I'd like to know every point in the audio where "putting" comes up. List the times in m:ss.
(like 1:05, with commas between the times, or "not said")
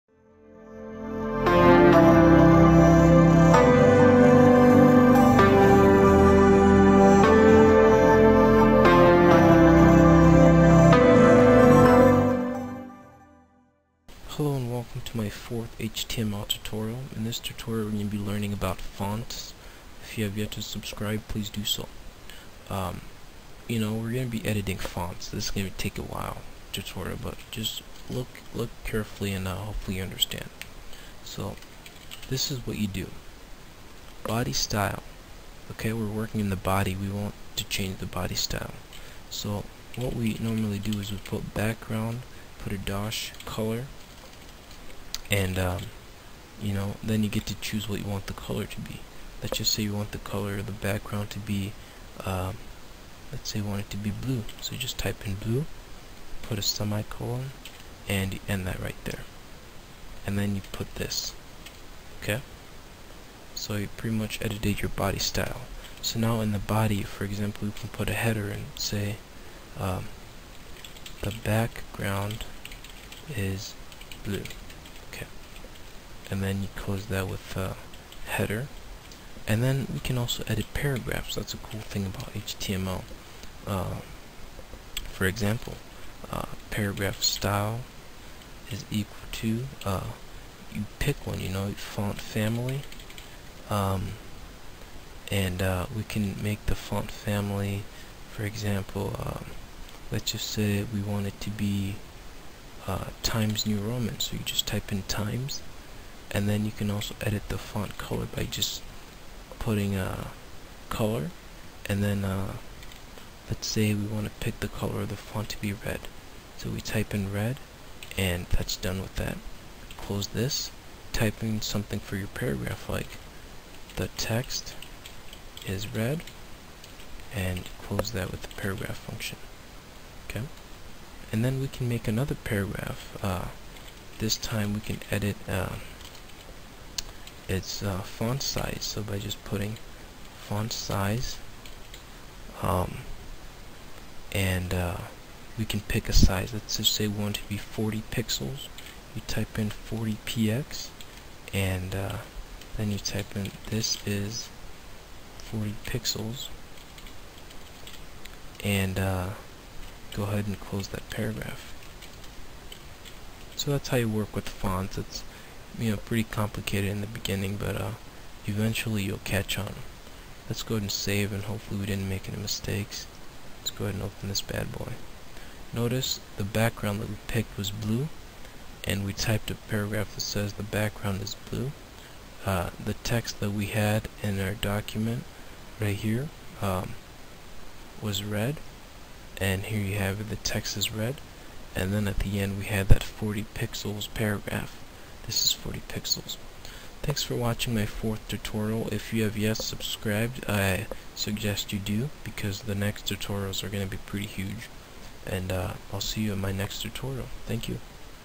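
1:49, 2:19.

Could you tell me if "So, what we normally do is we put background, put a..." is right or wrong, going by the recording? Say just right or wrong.
right.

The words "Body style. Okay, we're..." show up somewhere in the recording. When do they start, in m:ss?
0:34.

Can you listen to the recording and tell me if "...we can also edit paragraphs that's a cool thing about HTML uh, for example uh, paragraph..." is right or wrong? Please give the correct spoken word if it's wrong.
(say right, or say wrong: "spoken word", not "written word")
right.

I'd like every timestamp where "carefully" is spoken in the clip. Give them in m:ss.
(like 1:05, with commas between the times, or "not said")
0:28.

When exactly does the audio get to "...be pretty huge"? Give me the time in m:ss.
3:23.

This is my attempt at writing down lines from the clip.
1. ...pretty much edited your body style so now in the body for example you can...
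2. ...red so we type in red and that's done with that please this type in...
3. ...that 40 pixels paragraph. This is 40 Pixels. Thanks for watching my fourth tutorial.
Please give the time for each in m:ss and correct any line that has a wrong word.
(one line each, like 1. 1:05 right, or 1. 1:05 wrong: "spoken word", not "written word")
1. 1:03 right
2. 1:55 wrong: "close", not "please"
3. 3:12 right.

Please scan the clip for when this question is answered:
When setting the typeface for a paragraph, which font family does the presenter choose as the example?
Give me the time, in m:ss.
1:43.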